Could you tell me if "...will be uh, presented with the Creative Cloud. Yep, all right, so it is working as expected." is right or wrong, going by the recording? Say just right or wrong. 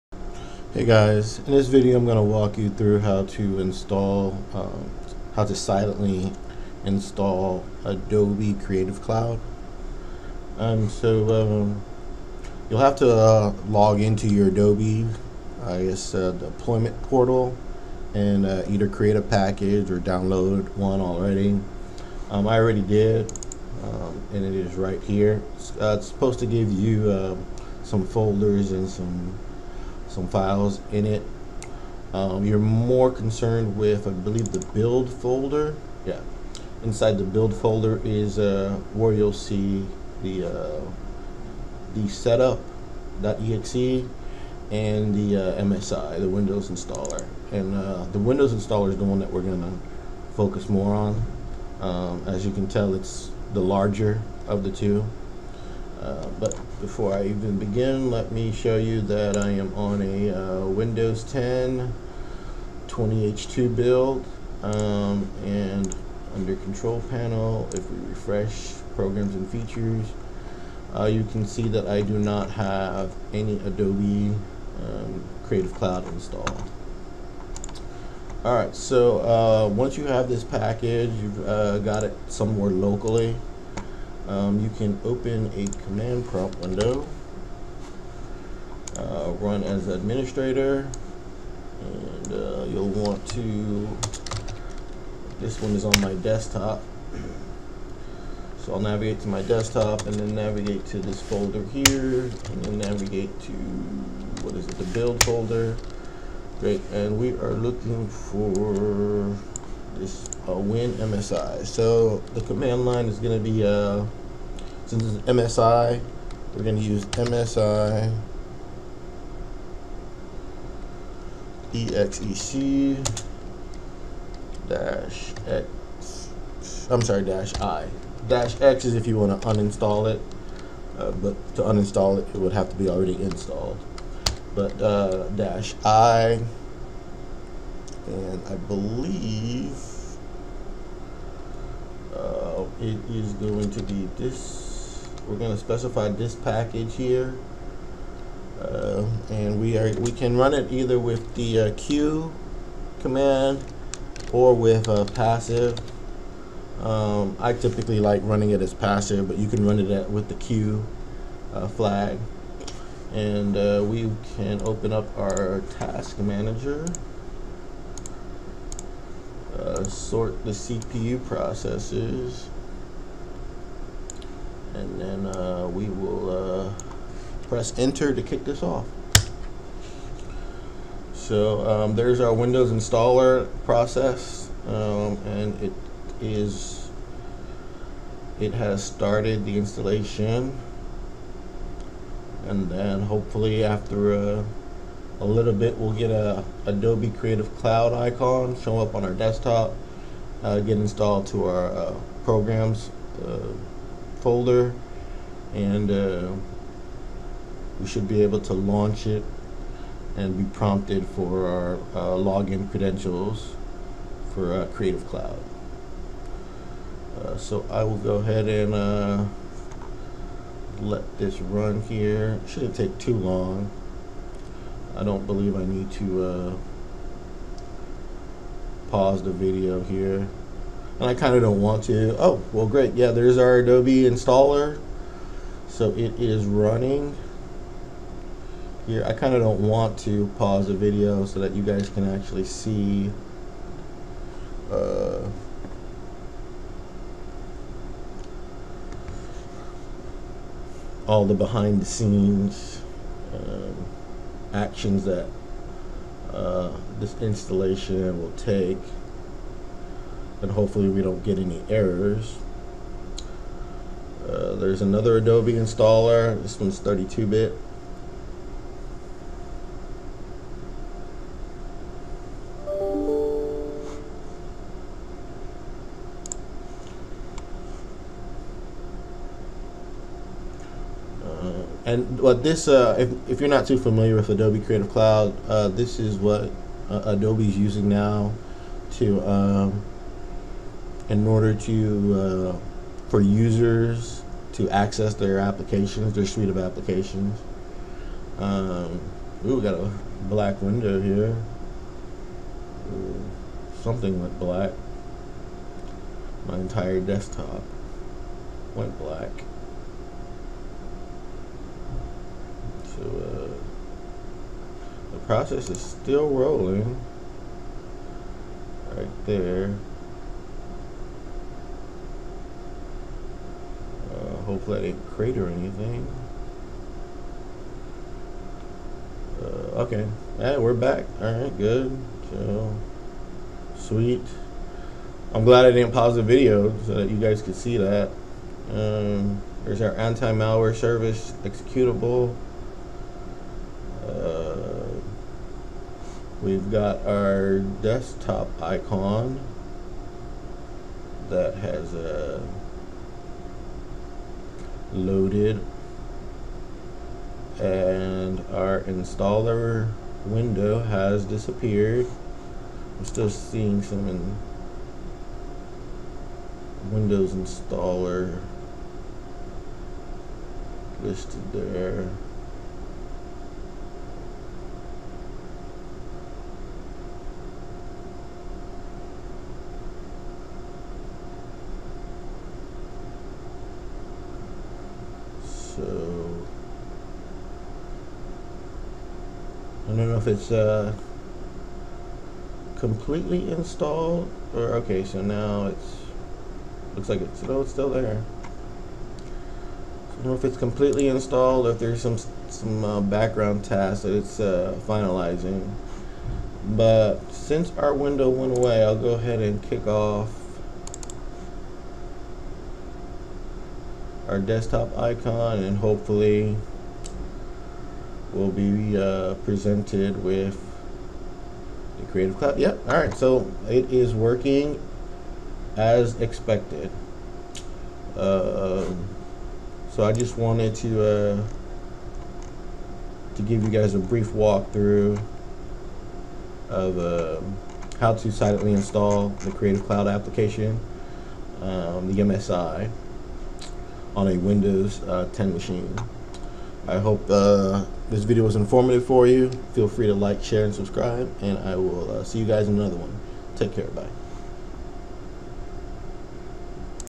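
right.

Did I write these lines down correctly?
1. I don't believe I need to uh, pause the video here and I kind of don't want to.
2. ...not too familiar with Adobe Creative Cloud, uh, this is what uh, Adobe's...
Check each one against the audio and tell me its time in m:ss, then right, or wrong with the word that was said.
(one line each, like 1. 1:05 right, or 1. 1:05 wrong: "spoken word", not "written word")
1. 3:44 right
2. 4:43 right.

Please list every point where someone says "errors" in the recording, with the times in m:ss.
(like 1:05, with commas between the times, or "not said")
4:21.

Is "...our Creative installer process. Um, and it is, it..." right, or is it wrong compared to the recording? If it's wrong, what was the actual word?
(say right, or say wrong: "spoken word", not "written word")
wrong: "Windows", not "Creative".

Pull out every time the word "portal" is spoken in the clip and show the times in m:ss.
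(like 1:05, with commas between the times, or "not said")
0:17.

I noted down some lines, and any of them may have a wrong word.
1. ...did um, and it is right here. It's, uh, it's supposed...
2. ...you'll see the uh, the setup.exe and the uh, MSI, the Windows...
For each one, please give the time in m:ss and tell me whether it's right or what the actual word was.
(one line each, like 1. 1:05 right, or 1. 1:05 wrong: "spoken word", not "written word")
1. 0:22 right
2. 0:39 right.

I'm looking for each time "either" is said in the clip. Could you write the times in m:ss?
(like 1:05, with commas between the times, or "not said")
0:18, 2:30.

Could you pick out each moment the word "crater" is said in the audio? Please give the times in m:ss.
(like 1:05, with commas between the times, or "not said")
5:25.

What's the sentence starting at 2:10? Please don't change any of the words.
Uh, but to uninstall it, it would have to be already installed.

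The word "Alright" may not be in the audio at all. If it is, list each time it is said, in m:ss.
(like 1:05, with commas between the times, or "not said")
1:18, 5:31.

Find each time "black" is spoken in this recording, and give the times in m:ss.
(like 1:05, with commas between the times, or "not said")
5:00, 5:04, 5:08.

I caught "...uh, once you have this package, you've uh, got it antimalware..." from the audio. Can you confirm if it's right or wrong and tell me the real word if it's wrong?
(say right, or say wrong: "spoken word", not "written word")
wrong: "somewhere", not "antimalware".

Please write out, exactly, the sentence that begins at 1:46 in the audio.
Great, and we are looking for this uh, win MSI.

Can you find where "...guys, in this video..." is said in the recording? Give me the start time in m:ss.
0:00.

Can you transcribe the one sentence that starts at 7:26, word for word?
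I hope uh, this video was informative for you.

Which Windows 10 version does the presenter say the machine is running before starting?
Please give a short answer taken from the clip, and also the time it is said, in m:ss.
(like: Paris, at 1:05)
20H2, at 1:02.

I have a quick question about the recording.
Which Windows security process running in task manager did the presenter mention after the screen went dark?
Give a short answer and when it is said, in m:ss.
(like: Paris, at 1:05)
anti-malware service executable, at 5:39.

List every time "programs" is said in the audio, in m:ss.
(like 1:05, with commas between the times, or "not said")
1:08, 3:22.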